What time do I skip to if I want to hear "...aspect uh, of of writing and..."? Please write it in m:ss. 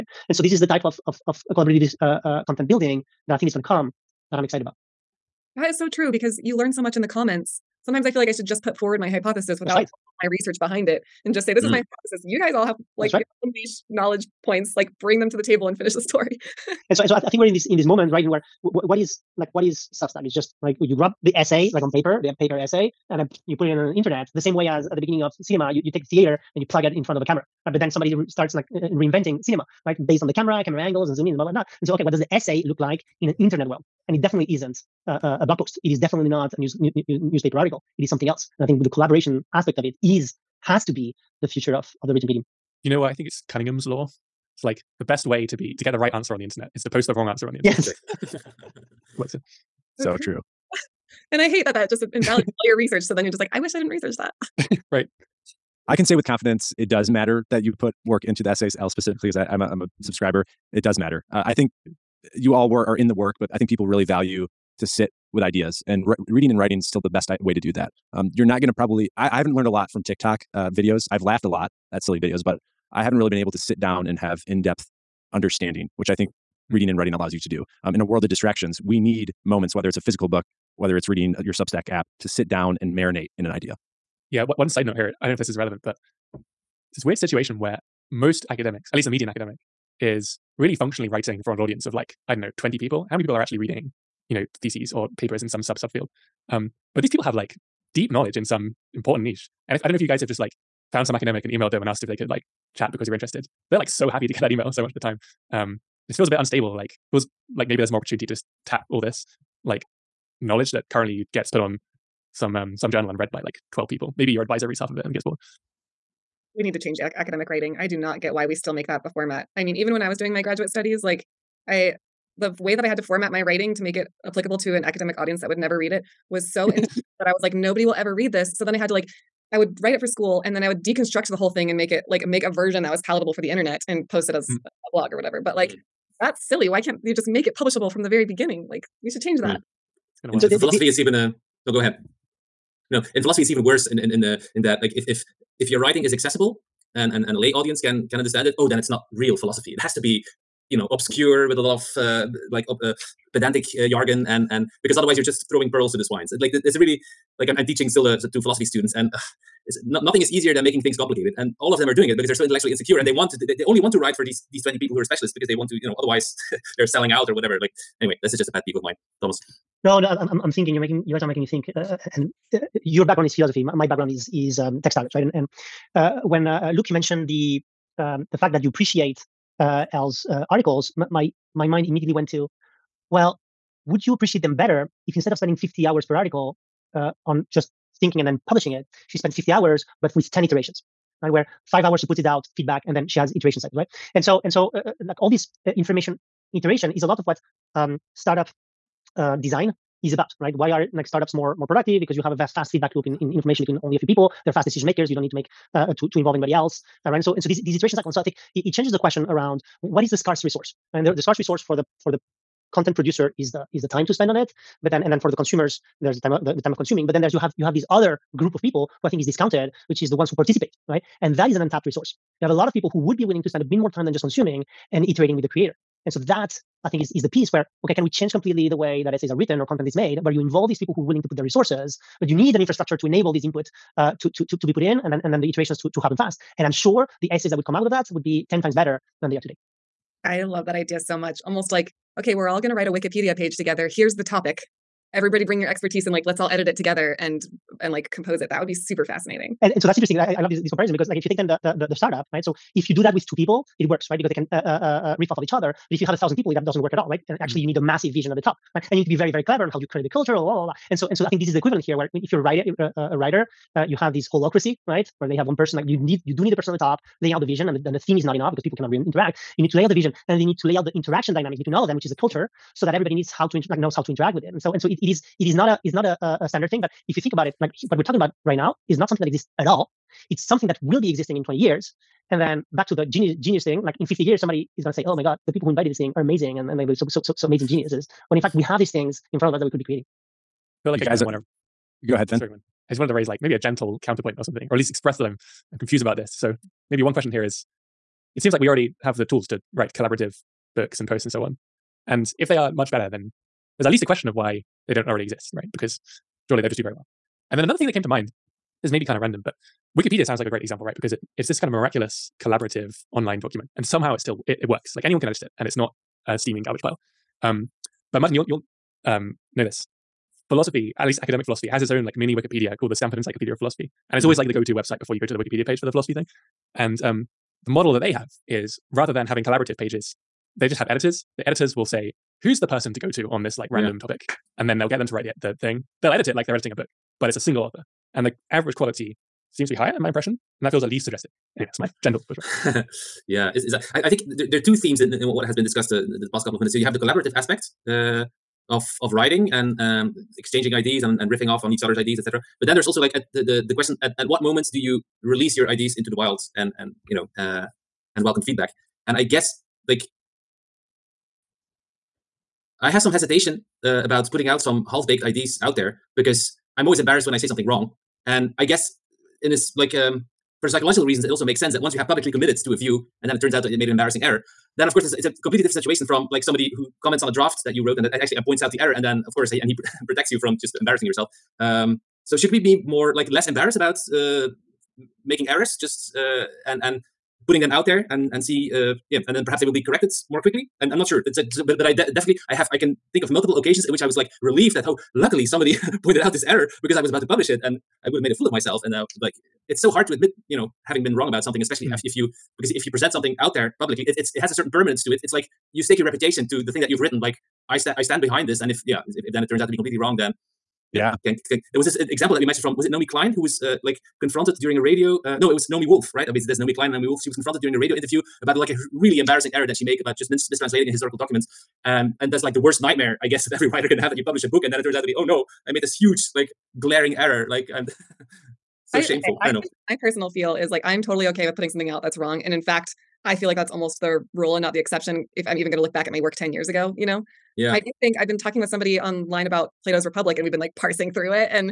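5:47.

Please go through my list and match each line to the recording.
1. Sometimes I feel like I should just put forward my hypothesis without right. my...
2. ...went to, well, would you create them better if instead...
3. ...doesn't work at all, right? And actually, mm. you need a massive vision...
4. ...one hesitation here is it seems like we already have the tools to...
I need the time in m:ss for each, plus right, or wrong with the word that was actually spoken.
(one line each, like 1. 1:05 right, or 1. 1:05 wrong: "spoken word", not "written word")
1. 0:07 right
2. 3:02 wrong: "appreciate", not "create"
3. 4:16 right
4. 4:57 wrong: "question", not "hesitation".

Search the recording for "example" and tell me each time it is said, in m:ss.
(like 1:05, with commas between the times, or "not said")
5:10, 6:52.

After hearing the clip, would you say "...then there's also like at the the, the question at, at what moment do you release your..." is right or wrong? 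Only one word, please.
right.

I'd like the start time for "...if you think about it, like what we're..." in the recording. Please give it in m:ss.
4:37.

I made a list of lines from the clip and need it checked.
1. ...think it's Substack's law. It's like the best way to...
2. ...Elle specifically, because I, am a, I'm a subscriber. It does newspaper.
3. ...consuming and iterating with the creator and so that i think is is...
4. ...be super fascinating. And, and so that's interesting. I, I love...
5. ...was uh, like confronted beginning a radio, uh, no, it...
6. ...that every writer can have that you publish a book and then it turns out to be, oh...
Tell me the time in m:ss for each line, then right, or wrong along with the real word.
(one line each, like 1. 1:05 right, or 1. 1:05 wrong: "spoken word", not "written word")
1. 0:43 wrong: "Cunningham", not "Substack"
2. 0:58 wrong: "matter", not "newspaper"
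3. 3:44 right
4. 4:08 right
5. 6:53 wrong: "during", not "beginning"
6. 7:03 right.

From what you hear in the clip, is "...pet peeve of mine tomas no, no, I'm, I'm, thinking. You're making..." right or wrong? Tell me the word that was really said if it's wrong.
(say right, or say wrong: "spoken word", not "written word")
right.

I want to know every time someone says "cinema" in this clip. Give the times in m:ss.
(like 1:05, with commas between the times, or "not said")
0:25, 0:29.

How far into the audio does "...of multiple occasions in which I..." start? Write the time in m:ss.
6:33.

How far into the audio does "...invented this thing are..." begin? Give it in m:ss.
4:45.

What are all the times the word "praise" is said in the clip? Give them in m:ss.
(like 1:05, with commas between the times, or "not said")
not said.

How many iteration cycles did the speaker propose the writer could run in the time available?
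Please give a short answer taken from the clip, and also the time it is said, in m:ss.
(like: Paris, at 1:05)
10, at 3:10.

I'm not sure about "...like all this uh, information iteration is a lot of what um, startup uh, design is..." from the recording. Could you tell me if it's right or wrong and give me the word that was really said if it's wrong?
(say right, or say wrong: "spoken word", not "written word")
right.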